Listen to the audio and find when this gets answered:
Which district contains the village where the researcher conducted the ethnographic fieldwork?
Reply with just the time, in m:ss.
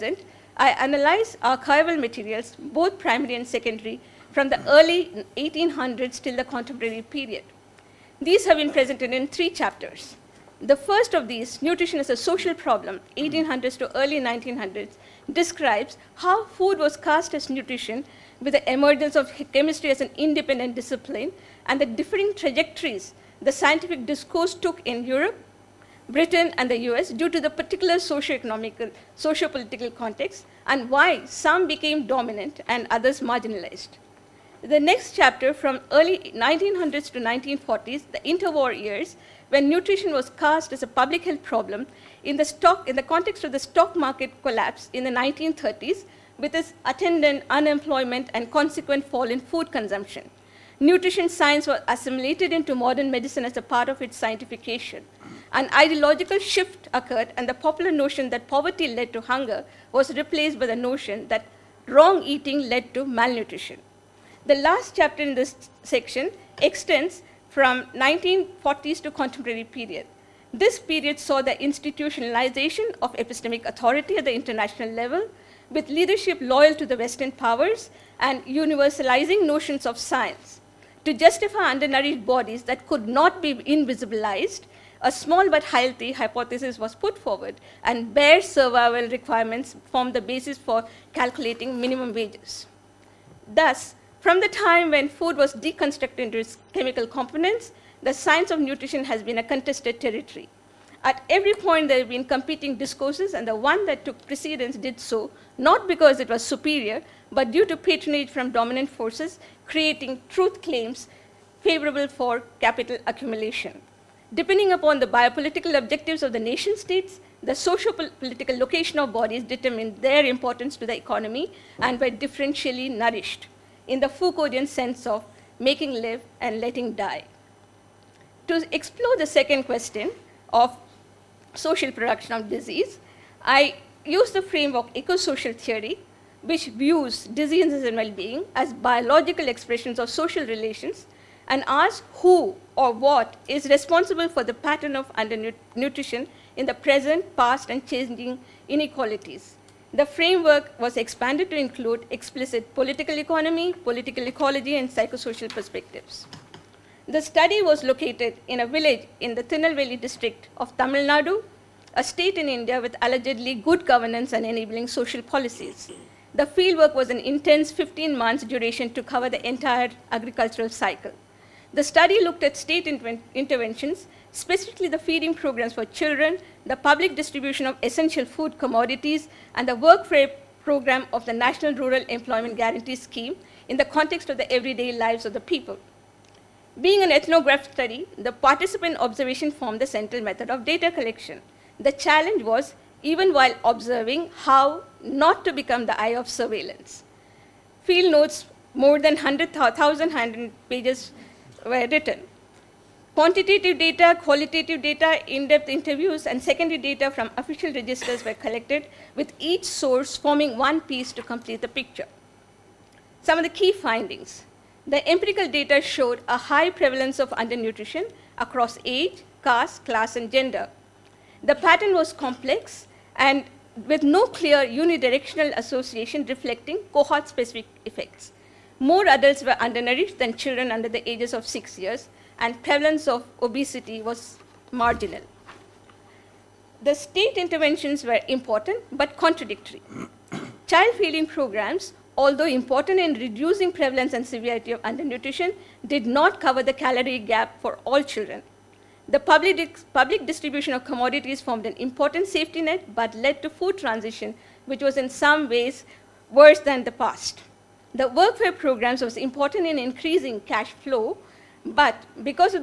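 2:39.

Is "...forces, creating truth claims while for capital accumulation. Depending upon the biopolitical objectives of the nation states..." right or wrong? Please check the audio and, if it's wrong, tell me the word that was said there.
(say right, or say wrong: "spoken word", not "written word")
wrong: "favorable", not "while".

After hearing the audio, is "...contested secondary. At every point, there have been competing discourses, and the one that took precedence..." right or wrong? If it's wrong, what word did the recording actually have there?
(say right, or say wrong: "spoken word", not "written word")
wrong: "territory", not "secondary".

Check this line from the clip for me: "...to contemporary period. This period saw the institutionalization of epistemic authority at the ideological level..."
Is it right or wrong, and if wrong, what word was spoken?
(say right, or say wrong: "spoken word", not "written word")
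wrong: "international", not "ideological".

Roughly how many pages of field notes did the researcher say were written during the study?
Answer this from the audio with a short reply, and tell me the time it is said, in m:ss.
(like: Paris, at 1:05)
100,000, at 3:19.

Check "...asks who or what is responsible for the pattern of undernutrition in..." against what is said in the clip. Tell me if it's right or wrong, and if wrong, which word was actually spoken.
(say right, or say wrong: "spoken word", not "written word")
right.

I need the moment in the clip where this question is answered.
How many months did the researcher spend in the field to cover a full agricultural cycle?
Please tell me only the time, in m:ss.
2:47.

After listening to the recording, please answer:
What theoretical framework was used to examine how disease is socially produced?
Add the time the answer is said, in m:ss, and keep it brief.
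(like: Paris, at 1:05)
eco-social theory, at 2:14.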